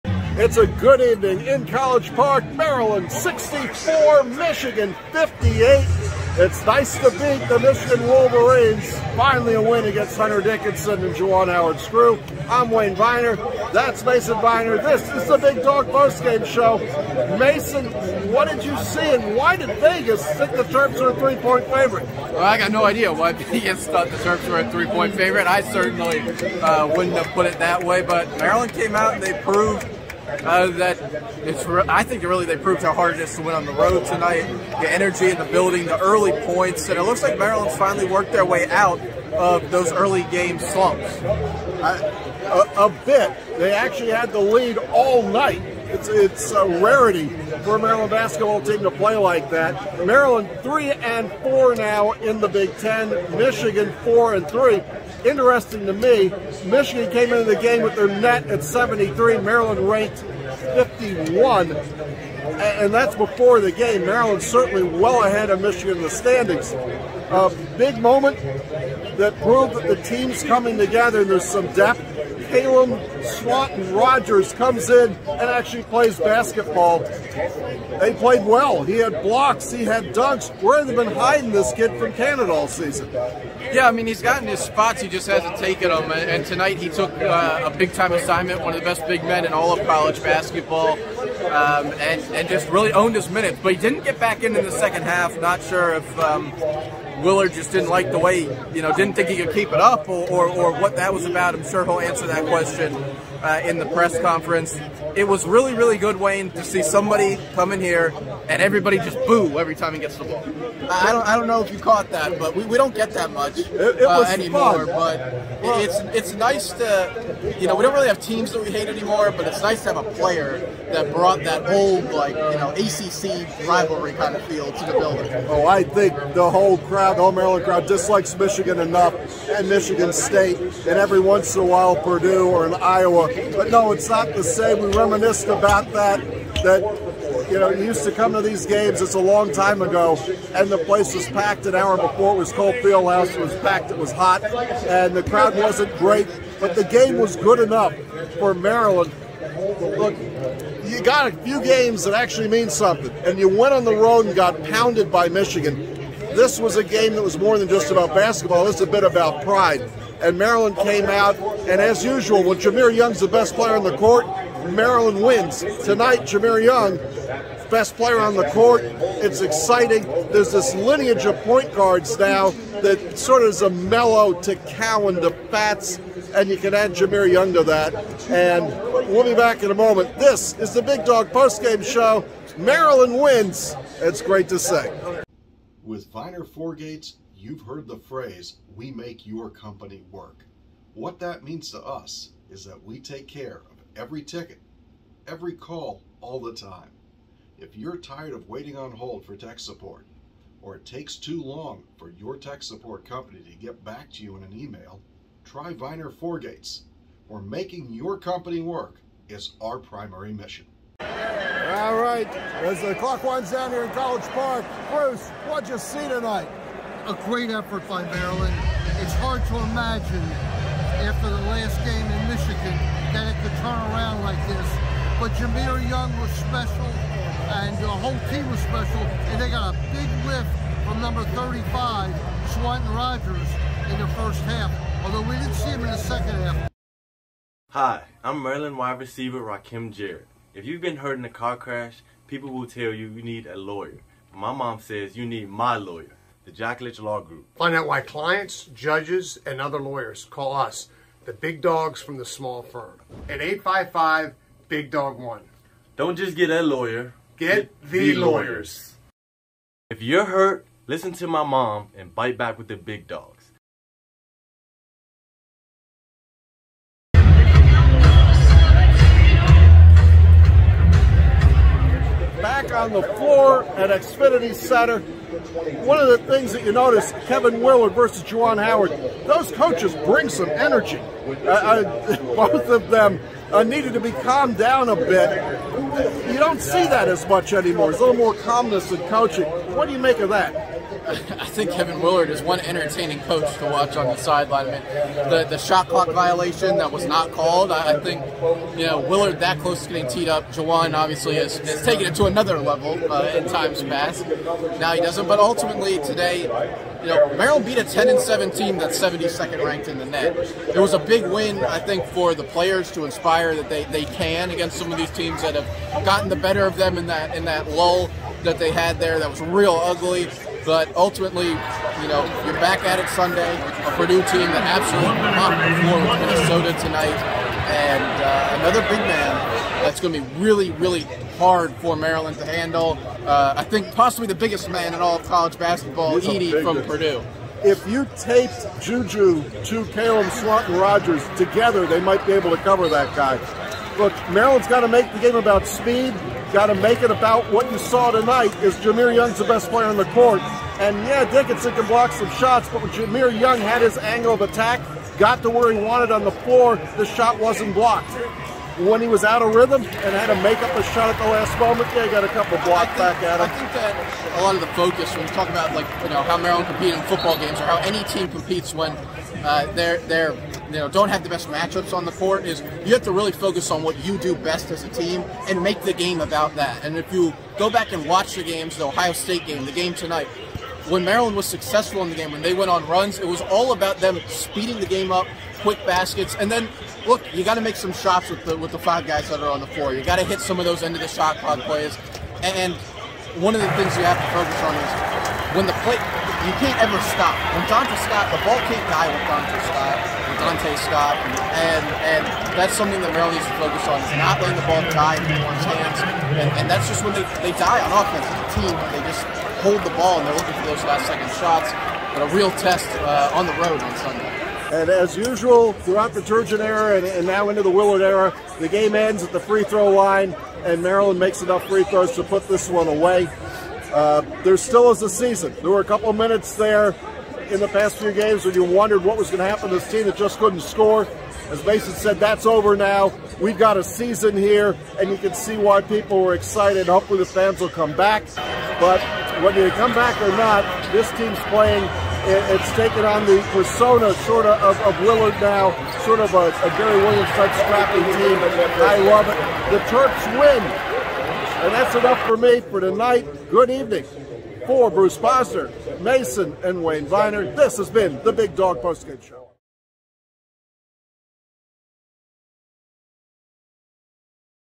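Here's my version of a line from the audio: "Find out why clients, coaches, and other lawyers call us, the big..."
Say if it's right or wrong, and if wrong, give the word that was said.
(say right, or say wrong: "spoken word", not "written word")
wrong: "judges", not "coaches".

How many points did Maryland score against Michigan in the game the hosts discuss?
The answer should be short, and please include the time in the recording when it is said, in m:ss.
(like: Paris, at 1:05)
64, at 0:02.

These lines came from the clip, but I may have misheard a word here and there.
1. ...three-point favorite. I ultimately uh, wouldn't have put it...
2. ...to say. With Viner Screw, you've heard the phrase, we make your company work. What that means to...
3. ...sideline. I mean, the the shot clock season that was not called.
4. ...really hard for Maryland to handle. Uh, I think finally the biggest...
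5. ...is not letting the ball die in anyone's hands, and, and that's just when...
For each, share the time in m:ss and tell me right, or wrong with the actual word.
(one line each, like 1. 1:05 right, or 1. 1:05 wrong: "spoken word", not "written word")
1. 0:24 wrong: "certainly", not "ultimately"
2. 3:04 wrong: "Gates", not "Screw"
3. 4:54 wrong: "violation", not "season"
4. 5:30 wrong: "possibly", not "finally"
5. 6:44 right.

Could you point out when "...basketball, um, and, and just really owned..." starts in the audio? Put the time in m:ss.
1:30.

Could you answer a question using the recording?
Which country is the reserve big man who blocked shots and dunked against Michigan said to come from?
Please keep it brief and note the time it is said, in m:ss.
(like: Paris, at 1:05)
Canada, at 1:22.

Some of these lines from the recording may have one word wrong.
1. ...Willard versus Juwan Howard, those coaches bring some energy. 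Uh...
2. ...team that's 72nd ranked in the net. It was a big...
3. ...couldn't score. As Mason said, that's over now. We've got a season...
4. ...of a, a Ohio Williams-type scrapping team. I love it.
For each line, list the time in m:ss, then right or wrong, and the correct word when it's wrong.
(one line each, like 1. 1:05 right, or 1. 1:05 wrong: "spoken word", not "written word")
1. 4:37 right
2. 5:08 right
3. 7:10 right
4. 7:26 wrong: "Gary", not "Ohio".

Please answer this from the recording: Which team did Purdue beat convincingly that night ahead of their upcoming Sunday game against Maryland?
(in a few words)
Minnesota.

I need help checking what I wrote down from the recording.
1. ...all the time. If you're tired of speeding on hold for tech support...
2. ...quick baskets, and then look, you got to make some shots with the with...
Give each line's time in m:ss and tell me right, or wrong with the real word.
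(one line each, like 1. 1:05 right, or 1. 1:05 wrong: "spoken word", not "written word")
1. 3:16 wrong: "waiting", not "speeding"
2. 6:25 right.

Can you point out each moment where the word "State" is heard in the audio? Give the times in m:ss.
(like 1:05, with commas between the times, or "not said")
2:10, 6:19.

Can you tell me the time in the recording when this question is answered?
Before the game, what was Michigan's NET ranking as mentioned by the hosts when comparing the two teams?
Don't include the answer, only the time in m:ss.
0:58.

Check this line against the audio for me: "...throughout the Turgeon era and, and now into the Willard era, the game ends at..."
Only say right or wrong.
right.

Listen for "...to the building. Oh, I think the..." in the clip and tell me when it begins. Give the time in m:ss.
2:04.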